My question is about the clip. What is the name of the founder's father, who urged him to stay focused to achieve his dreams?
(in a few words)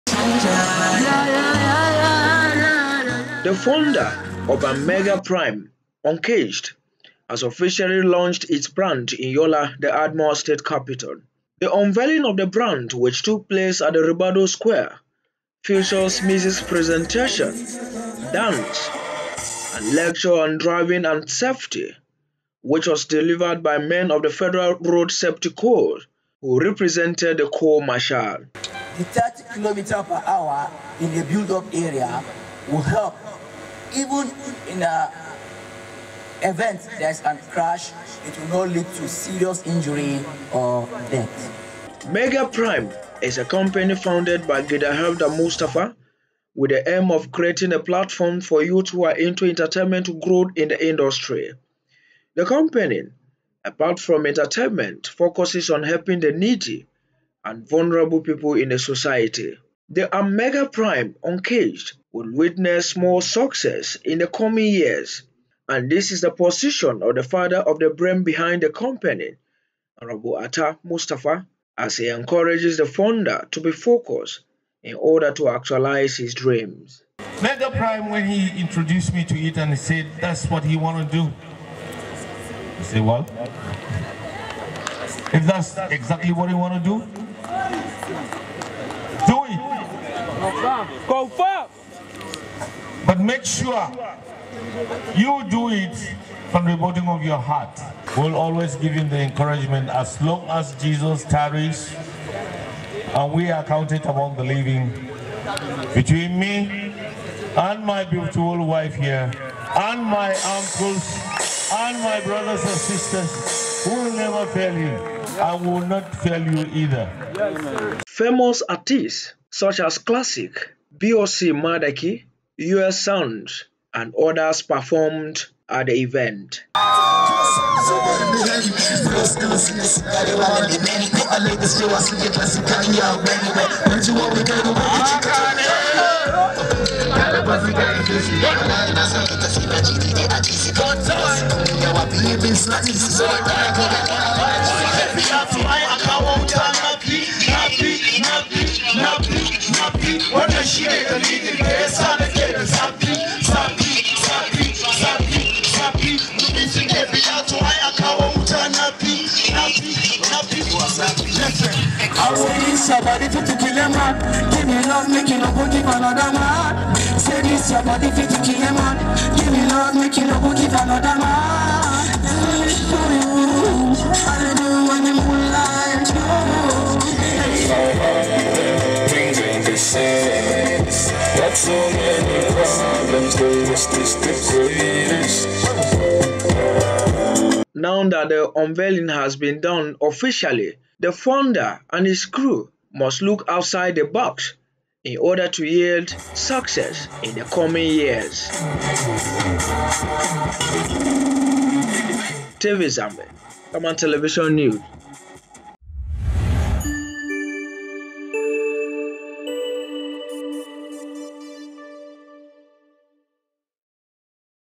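Atta Mustafa.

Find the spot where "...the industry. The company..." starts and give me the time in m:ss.
0:50.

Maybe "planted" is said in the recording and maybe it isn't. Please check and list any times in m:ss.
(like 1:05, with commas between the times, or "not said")
not said.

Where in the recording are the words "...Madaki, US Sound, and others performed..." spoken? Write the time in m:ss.
2:01.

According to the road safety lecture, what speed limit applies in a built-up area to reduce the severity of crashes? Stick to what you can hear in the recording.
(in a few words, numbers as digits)
30 km/h.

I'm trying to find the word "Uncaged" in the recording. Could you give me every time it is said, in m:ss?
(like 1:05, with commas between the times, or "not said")
0:06, 1:01.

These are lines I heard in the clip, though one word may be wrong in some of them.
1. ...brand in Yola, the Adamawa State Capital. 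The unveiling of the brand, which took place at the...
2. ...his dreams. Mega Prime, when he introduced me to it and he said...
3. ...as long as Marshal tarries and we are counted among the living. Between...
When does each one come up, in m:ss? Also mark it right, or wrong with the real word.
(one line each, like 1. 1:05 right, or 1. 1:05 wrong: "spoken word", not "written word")
1. 0:08 right
2. 1:16 right
3. 1:39 wrong: "Jesus", not "Marshal".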